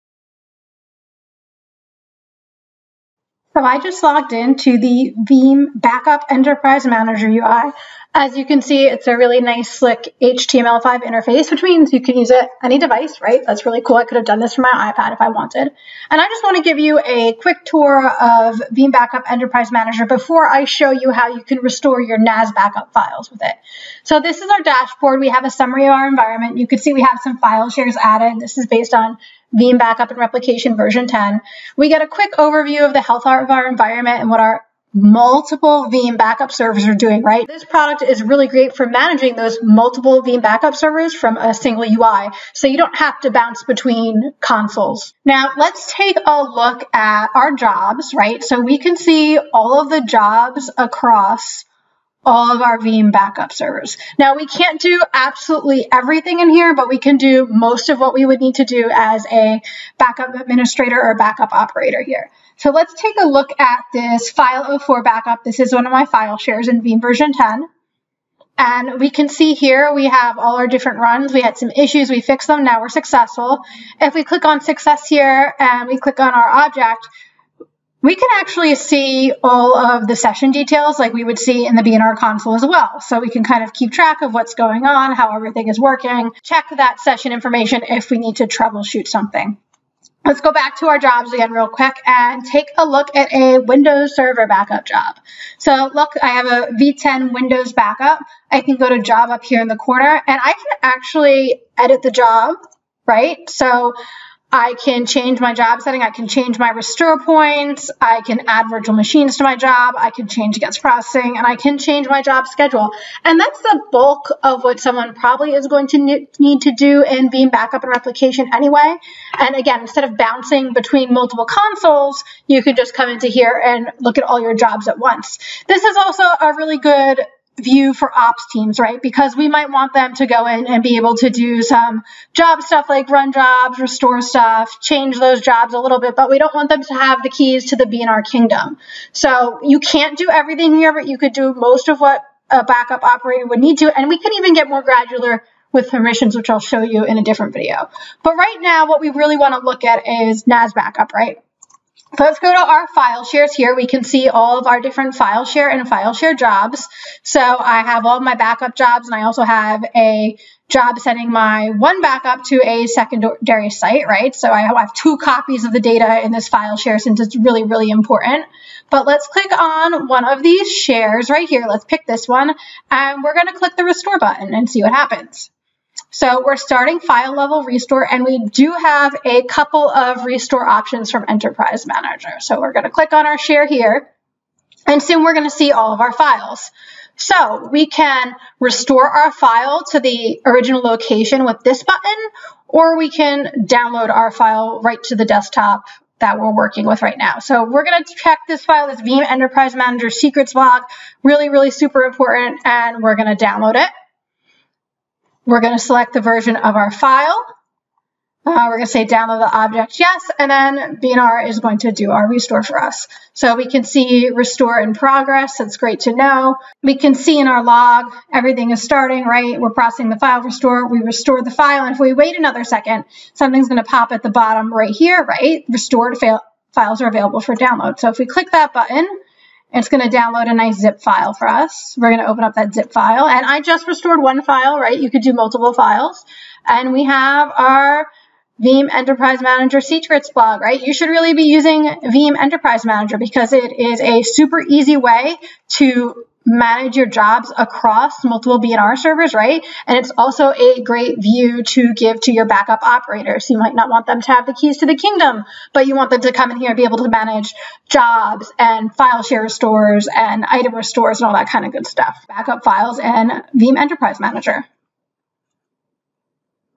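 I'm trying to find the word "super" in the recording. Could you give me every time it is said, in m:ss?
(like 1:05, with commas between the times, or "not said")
3:21, 4:04.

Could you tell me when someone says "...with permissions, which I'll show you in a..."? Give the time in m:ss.
2:25.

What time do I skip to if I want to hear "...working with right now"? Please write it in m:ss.
3:16.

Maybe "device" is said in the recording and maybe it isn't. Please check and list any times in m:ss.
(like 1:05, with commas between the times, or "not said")
0:12.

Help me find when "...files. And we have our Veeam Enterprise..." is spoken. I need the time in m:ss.
3:55.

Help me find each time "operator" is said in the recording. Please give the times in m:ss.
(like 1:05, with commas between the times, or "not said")
1:01, 2:23, 4:12.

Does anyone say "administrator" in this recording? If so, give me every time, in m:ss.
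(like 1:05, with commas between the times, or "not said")
1:00.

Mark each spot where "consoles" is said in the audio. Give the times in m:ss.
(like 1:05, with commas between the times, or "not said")
0:44, 1:22, 2:01.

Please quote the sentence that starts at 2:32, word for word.
So Let's go to our file shares here.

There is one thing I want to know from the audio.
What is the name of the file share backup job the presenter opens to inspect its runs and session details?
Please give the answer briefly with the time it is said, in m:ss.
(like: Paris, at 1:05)
file 04 backup, at 1:04.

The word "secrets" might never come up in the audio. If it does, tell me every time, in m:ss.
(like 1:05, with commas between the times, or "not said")
3:20, 3:59.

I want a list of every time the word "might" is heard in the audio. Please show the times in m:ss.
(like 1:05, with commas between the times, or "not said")
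2:09, 4:13.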